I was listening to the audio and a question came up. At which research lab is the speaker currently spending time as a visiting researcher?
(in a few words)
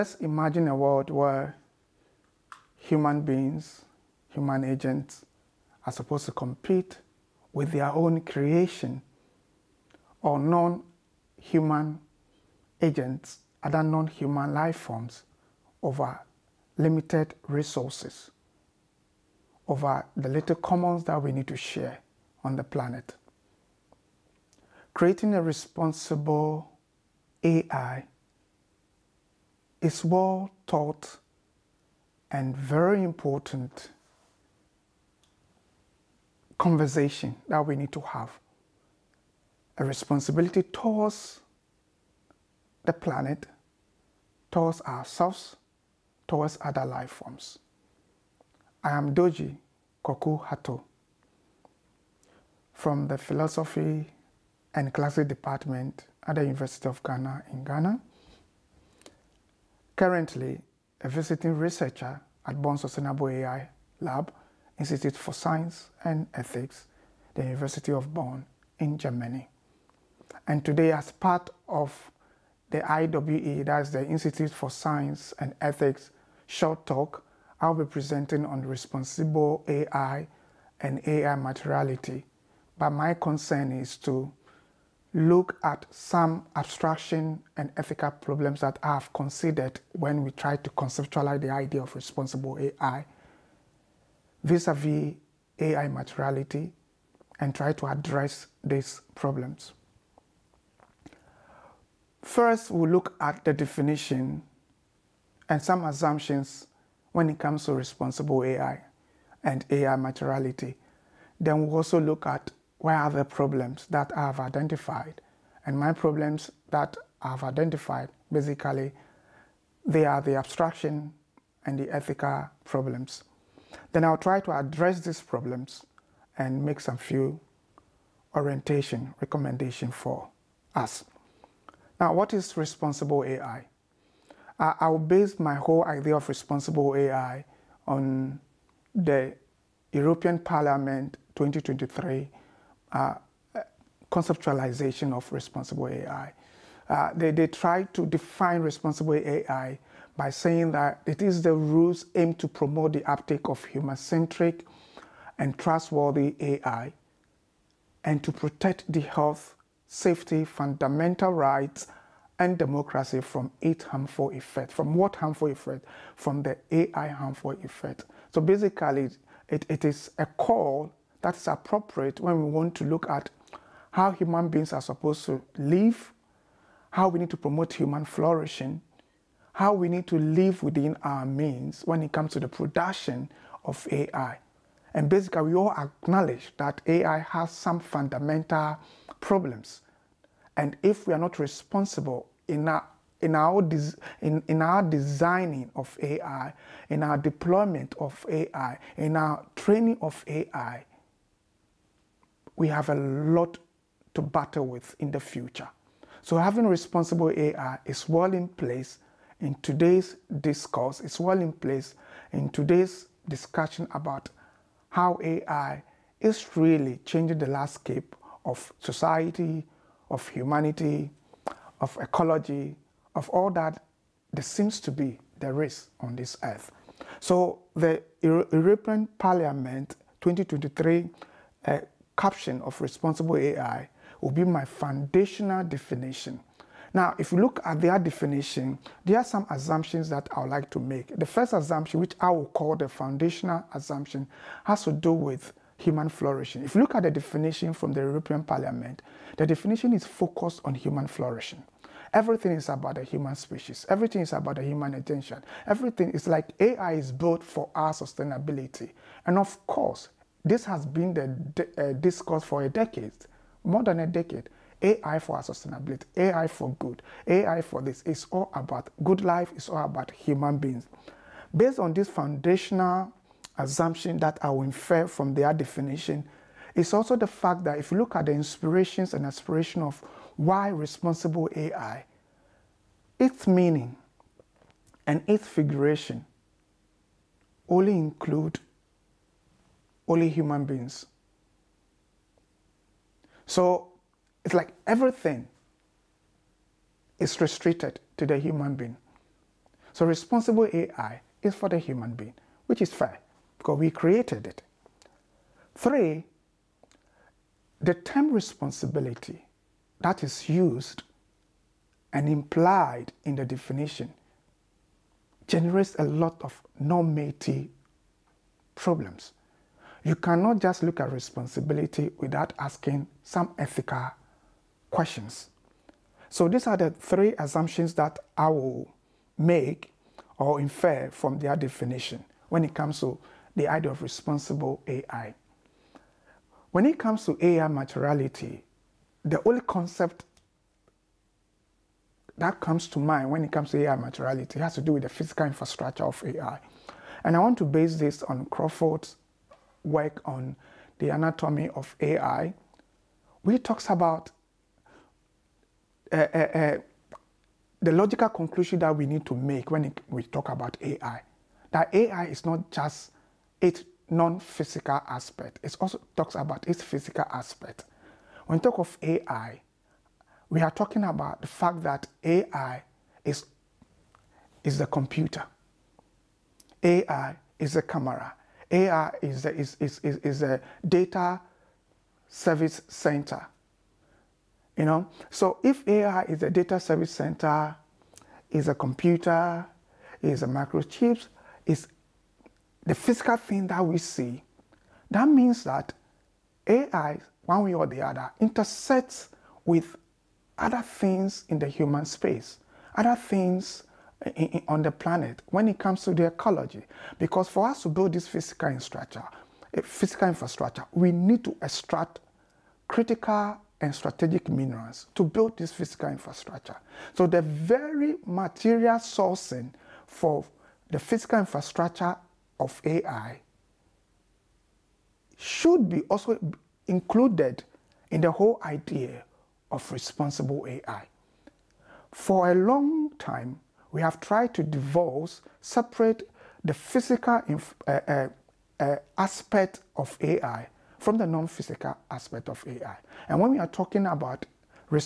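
Bonn Sustainable AI Lab.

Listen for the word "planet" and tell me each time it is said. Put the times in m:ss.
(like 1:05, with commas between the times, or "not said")
0:22, 0:42, 6:44.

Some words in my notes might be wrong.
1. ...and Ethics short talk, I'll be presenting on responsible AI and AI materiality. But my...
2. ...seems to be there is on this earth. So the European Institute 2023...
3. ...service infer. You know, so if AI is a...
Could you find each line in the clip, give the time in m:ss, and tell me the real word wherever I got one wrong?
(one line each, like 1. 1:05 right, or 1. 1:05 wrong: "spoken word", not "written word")
1. 1:15 right
2. 3:44 wrong: "Parliament", not "Institute"
3. 6:22 wrong: "center", not "infer".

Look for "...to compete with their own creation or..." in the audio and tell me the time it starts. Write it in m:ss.
0:06.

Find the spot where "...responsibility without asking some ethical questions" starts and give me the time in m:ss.
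5:21.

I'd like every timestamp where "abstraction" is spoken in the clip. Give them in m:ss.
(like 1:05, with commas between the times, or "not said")
1:26, 2:00.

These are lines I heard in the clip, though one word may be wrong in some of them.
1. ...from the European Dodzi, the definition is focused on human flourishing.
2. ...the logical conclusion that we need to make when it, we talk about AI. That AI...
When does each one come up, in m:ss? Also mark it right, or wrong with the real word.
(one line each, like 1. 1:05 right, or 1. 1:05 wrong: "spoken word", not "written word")
1. 4:07 wrong: "Parliament", not "Dodzi"
2. 5:57 right.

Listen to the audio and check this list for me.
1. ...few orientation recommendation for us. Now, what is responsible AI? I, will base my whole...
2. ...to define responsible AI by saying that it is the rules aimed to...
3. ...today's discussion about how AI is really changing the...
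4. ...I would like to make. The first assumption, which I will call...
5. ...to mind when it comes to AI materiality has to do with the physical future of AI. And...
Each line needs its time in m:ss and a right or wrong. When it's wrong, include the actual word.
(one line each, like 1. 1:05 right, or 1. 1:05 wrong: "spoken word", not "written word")
1. 2:06 right
2. 2:27 right
3. 3:32 right
4. 4:00 right
5. 5:42 wrong: "infrastructure", not "future".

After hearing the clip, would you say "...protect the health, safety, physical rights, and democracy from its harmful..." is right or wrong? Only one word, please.
wrong.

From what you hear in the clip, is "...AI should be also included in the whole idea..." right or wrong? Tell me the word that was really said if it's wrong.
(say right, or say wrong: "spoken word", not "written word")
right.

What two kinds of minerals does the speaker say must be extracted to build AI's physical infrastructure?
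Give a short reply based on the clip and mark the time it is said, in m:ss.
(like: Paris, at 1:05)
critical and strategic, at 6:52.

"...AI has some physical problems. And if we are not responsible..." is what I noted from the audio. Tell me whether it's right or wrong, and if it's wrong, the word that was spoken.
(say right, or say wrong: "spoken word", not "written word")
wrong: "fundamental", not "physical".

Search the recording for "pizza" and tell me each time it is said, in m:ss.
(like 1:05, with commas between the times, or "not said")
not said.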